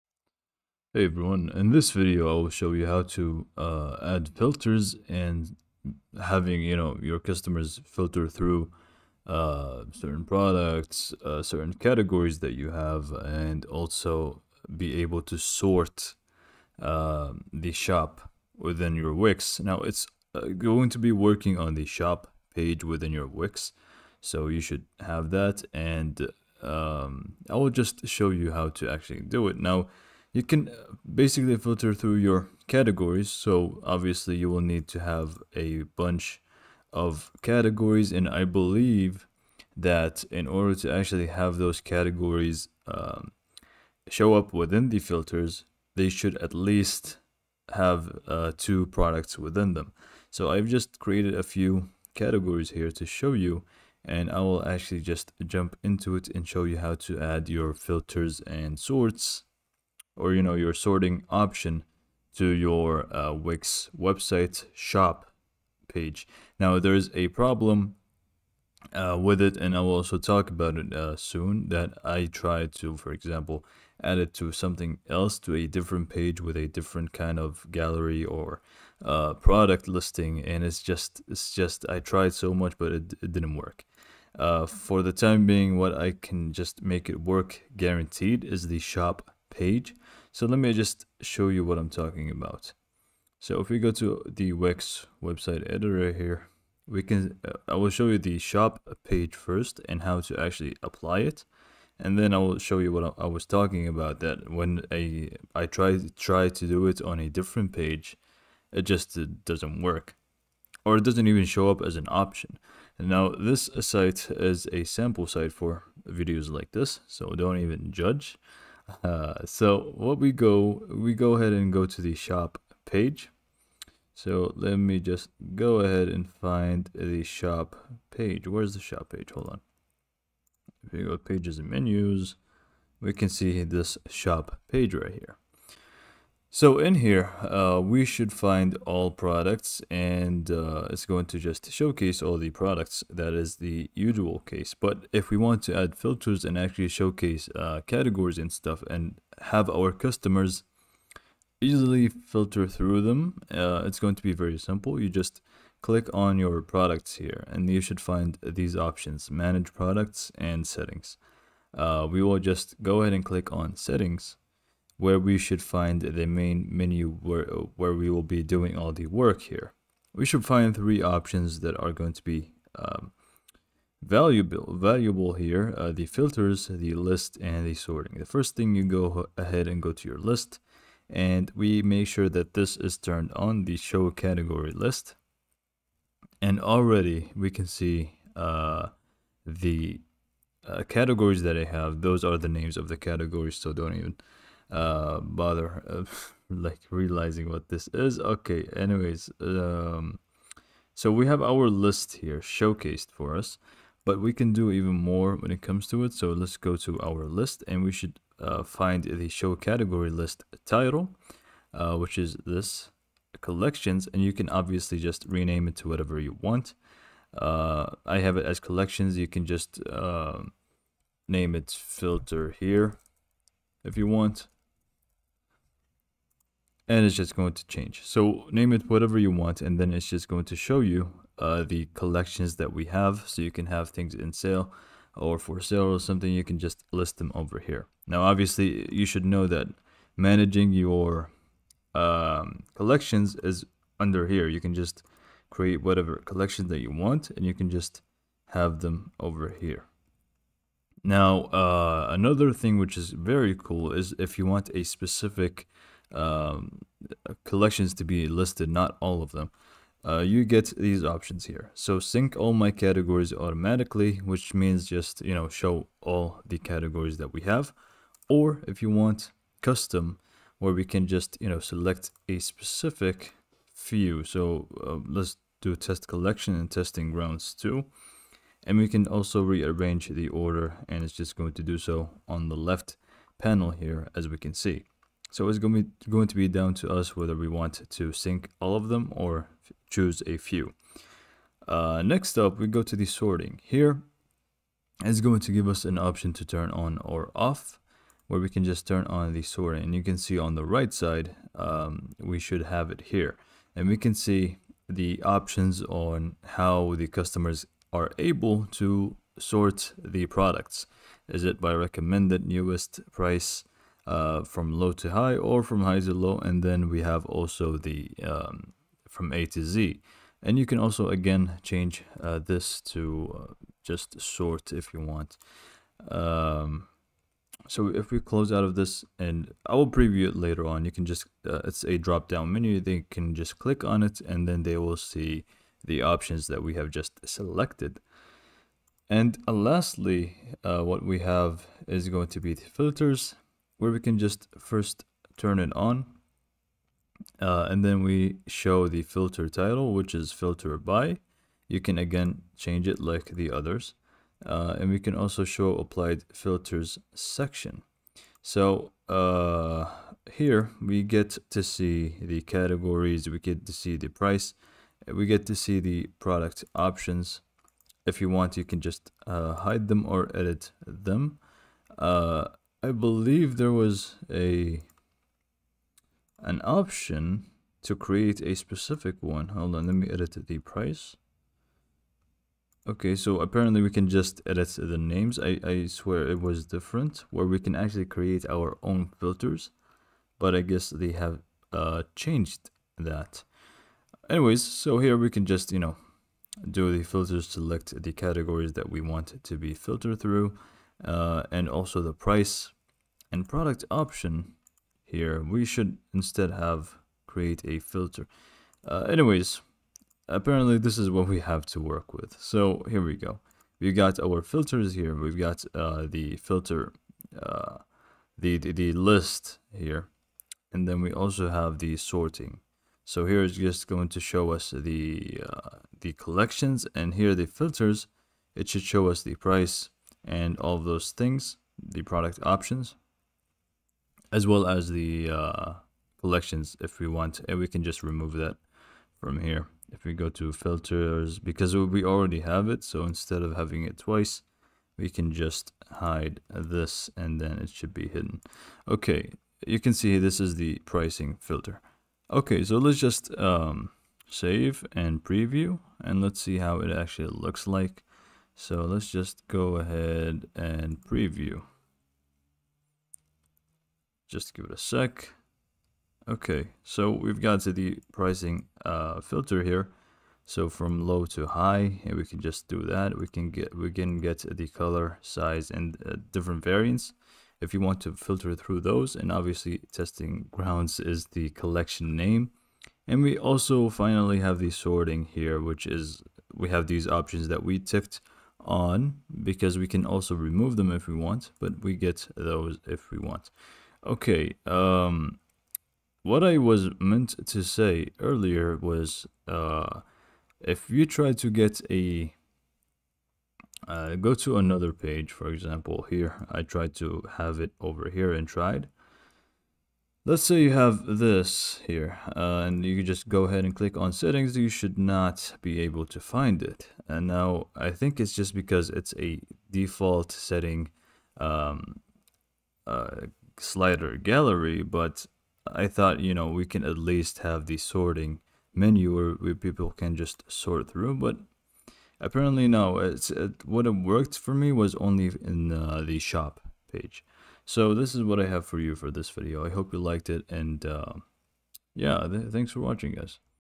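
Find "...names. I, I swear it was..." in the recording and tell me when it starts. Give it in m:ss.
6:24.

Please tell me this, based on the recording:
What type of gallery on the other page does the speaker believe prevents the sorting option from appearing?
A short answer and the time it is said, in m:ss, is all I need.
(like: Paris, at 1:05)
Slider gallery, at 8:43.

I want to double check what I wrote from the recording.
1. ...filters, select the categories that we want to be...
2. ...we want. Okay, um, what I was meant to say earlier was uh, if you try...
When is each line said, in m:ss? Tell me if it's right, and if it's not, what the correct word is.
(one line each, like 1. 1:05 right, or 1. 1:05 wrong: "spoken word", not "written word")
1. 6:37 right
2. 8:13 right.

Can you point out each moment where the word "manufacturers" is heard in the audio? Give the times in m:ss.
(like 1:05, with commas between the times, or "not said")
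not said.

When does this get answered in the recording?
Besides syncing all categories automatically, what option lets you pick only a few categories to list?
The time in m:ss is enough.
4:29.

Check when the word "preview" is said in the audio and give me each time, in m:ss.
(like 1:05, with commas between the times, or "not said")
5:29, 7:35, 7:41.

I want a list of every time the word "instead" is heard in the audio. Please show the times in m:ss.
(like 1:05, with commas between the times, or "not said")
6:46, 7:23.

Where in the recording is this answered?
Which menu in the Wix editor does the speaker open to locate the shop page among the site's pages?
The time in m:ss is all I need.
2:11.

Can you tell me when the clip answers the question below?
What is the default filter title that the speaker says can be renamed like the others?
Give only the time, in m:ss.
5:50.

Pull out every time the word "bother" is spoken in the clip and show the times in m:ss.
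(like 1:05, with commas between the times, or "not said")
3:15.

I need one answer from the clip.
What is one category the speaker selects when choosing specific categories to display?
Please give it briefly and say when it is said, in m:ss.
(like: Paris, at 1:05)
Test collection, at 4:35.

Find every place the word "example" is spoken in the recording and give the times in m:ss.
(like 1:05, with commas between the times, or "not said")
1:13, 8:25.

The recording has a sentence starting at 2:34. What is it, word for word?
You just click on your products here and you should find these options, manage products and settings.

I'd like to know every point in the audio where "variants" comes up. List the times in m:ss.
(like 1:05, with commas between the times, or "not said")
7:56.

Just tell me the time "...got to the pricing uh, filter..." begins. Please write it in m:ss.
7:47.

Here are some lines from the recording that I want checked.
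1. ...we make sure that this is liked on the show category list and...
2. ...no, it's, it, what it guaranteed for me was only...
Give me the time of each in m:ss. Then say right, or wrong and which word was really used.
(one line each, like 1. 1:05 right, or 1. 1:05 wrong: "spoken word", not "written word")
1. 3:01 wrong: "turned", not "liked"
2. 8:52 wrong: "worked", not "guaranteed".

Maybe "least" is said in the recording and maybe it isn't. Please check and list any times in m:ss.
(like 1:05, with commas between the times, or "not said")
0:46, 8:46.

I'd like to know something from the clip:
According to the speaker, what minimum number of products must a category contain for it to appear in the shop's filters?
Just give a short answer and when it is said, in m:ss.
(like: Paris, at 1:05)
2, at 0:48.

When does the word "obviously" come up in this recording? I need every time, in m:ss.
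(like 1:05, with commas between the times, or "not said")
0:33, 3:34, 3:58, 7:59.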